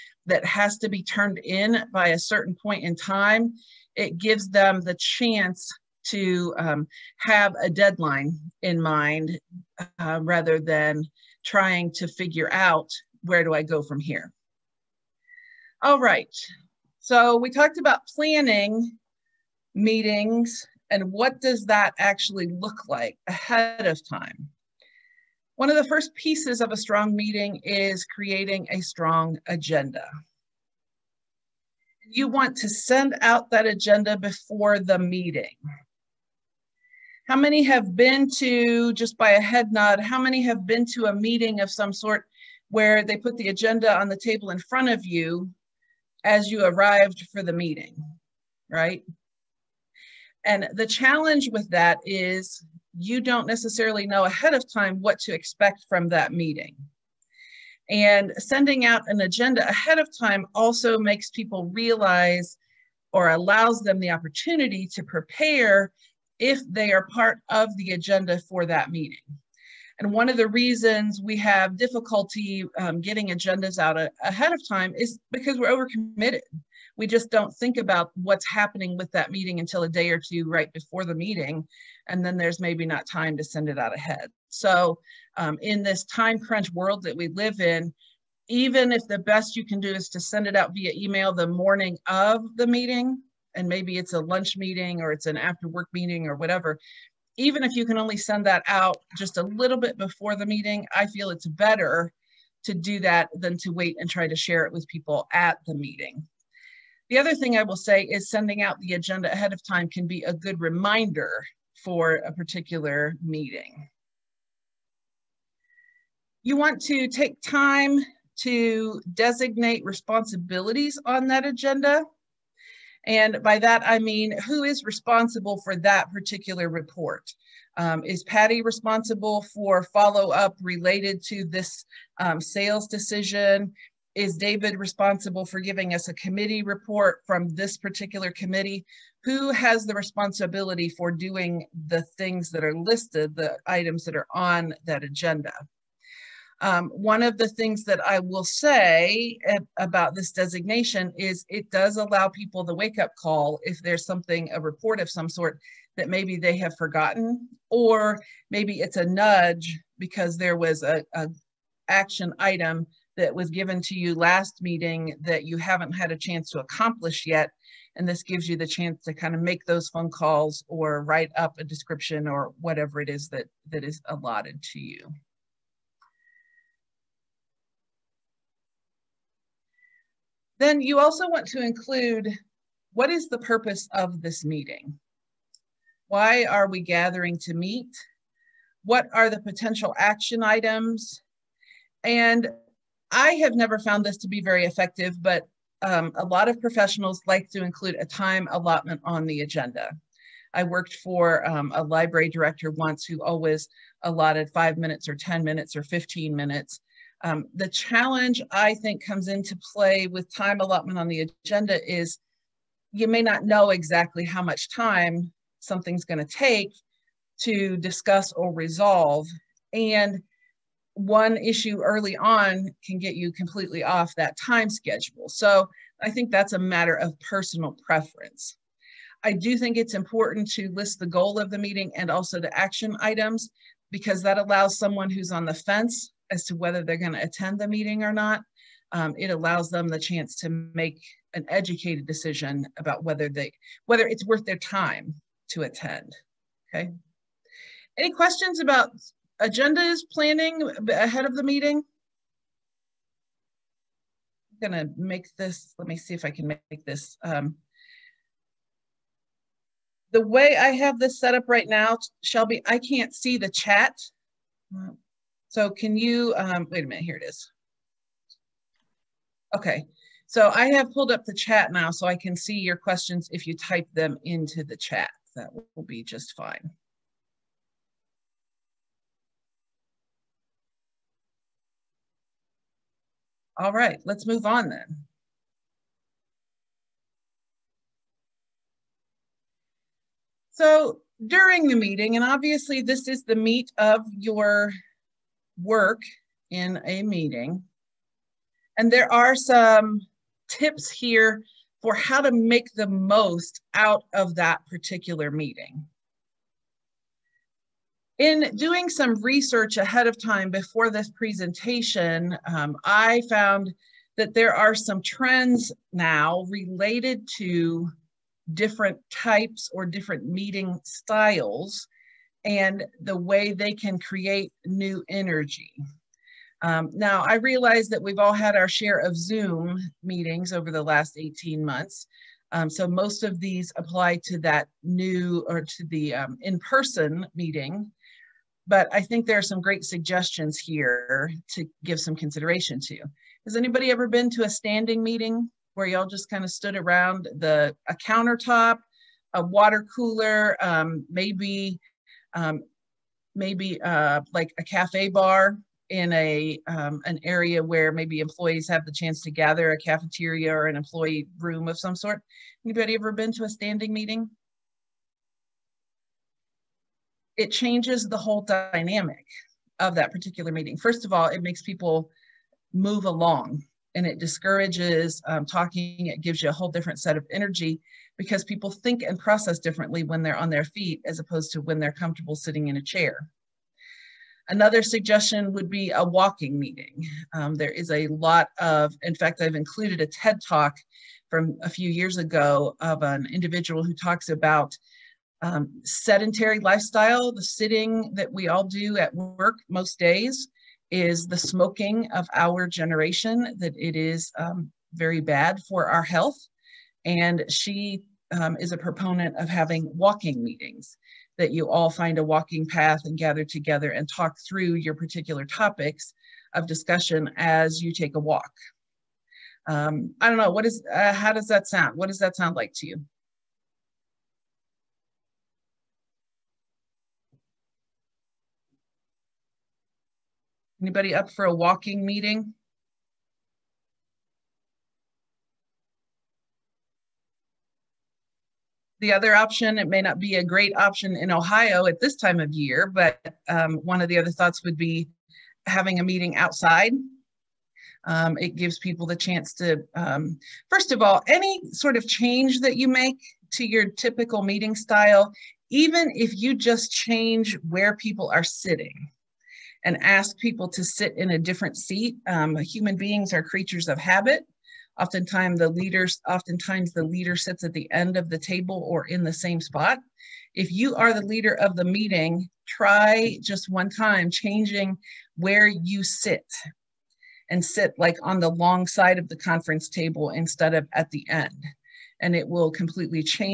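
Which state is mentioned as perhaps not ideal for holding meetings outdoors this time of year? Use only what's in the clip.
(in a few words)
Ohio.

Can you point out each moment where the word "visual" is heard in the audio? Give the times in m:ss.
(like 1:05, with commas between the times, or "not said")
not said.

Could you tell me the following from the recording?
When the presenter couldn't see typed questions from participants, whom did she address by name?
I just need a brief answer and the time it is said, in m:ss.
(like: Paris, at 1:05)
Shelby, at 4:22.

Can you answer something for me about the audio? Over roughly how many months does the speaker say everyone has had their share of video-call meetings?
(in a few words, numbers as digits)
18.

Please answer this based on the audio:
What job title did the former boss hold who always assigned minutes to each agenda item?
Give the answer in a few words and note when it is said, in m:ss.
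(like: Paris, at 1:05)
Library director, at 3:21.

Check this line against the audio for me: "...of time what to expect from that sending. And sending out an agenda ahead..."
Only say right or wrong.
wrong.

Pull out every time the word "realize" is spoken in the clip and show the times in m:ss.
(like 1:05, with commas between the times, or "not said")
1:01, 5:27.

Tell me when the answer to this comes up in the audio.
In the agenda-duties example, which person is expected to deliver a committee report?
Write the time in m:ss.
2:14.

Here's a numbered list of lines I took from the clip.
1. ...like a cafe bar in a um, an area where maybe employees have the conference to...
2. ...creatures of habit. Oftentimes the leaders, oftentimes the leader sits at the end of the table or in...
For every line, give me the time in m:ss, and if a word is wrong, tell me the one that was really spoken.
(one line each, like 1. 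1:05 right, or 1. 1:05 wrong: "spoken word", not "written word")
1. 5:54 wrong: "chance", not "conference"
2. 7:43 right.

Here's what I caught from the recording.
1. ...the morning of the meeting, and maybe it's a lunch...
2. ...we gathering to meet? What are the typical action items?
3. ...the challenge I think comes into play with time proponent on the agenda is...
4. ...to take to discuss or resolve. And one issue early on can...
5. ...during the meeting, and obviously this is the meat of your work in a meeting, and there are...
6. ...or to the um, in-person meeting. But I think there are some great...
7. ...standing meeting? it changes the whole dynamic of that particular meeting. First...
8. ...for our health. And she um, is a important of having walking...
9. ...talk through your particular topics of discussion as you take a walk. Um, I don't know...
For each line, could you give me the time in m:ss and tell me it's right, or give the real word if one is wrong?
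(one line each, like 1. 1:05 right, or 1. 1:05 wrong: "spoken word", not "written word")
1. 1:31 right
2. 3:06 wrong: "potential", not "typical"
3. 3:27 wrong: "allotment", not "proponent"
4. 3:36 right
5. 4:51 right
6. 5:35 right
7. 6:03 right
8. 6:45 wrong: "proponent", not "important"
9. 6:54 right.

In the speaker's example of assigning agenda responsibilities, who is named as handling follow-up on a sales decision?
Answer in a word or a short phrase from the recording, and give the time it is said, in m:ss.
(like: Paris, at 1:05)
Patty, at 2:08.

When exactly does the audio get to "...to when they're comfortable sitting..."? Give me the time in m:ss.
6:21.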